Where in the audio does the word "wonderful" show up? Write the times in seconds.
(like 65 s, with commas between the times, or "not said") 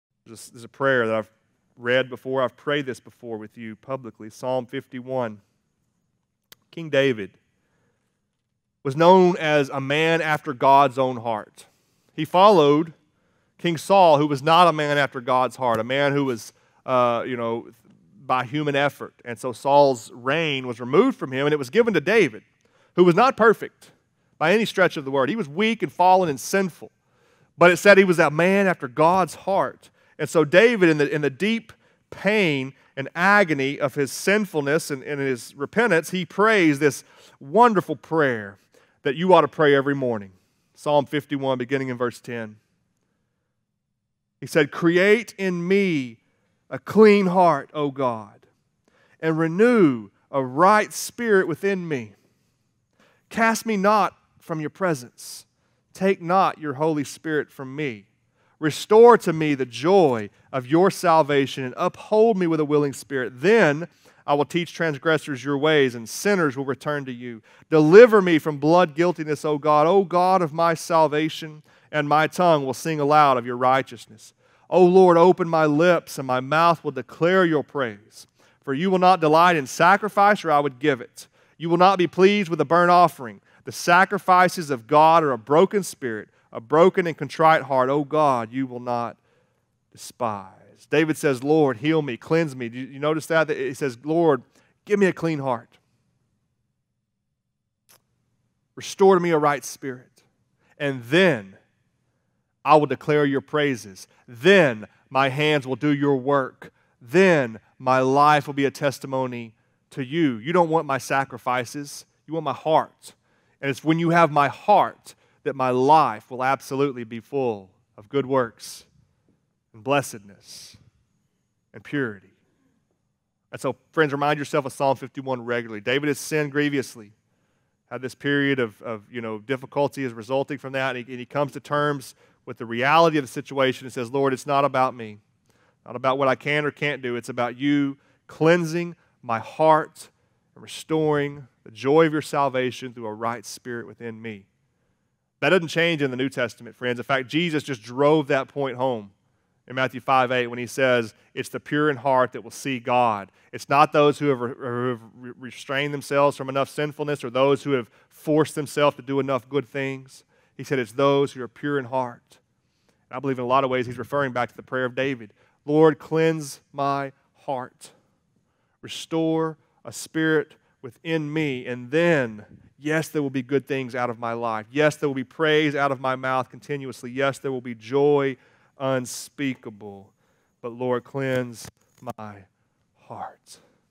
37 s.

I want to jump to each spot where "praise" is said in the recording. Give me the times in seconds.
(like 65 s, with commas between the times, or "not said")
77 s, 103 s, 175 s.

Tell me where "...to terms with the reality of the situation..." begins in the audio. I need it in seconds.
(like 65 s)
131 s.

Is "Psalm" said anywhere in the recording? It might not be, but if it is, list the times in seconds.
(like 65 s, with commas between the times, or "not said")
4 s, 40 s, 124 s.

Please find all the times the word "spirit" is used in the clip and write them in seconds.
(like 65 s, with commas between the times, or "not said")
50 s, 57 s, 62 s, 85 s, 99 s, 143 s, 169 s.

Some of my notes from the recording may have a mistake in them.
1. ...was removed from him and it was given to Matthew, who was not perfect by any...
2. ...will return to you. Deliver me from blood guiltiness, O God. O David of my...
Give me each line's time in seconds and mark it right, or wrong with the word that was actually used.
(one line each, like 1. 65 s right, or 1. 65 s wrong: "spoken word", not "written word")
1. 20 s wrong: "David", not "Matthew"
2. 66 s wrong: "God", not "David".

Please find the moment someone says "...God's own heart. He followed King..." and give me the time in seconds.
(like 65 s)
10 s.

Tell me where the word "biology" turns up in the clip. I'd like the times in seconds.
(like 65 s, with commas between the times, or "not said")
not said.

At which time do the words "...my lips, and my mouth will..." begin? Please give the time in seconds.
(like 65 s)
75 s.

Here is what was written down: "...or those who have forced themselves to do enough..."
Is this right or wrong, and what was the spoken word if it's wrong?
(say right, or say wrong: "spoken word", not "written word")
right.